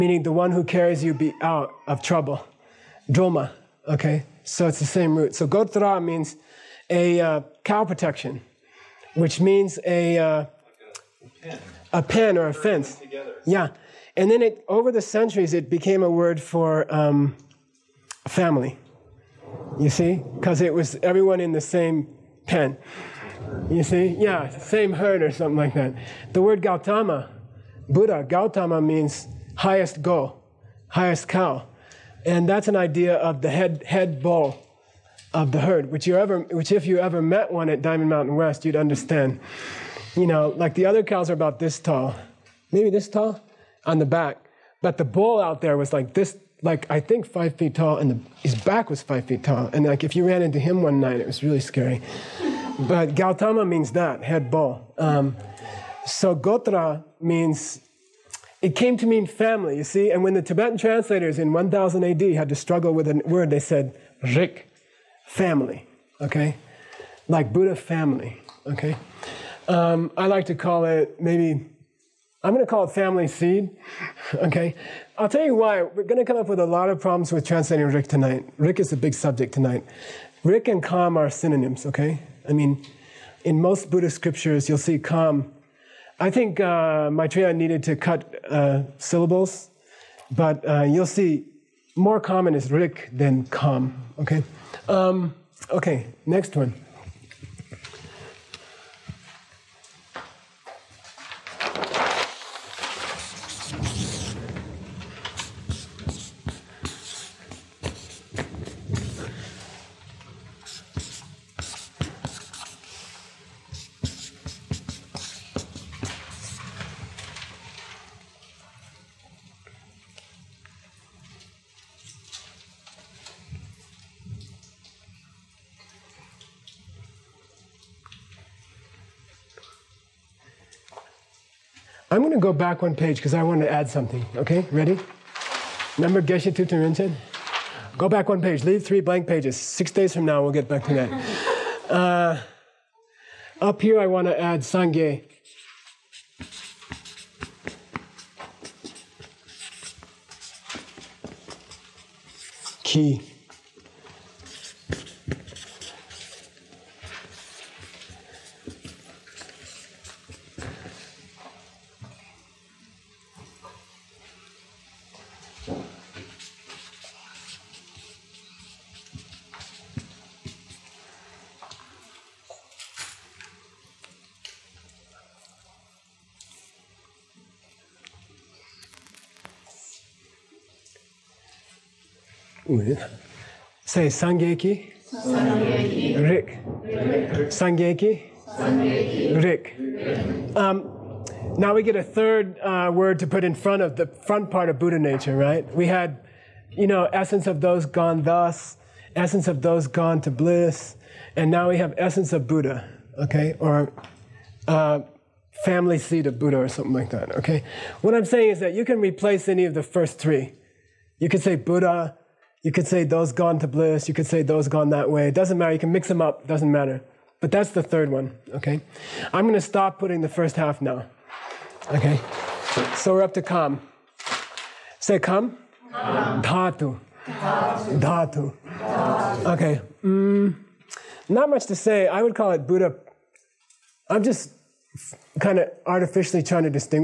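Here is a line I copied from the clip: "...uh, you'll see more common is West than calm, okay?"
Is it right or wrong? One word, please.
wrong.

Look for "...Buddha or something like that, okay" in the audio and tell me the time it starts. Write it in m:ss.
3:26.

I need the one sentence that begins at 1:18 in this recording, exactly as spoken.
Rick is a big subject tonight.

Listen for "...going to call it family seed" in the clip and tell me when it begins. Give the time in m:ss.
1:12.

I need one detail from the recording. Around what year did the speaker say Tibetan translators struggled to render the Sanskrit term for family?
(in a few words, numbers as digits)
1000 AD.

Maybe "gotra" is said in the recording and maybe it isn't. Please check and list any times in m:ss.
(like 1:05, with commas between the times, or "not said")
0:05, 0:56.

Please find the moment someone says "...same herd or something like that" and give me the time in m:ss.
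0:24.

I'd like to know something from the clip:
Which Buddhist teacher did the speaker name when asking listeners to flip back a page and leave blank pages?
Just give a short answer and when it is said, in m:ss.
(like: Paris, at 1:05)
Geshe Thupten Rinchen, at 2:16.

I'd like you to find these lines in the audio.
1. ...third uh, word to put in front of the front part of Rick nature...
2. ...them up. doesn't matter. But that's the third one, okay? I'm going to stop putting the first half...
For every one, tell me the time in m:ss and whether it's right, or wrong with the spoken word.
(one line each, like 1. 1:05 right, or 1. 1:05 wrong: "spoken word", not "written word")
1. 3:12 wrong: "Buddha", not "Rick"
2. 3:36 right.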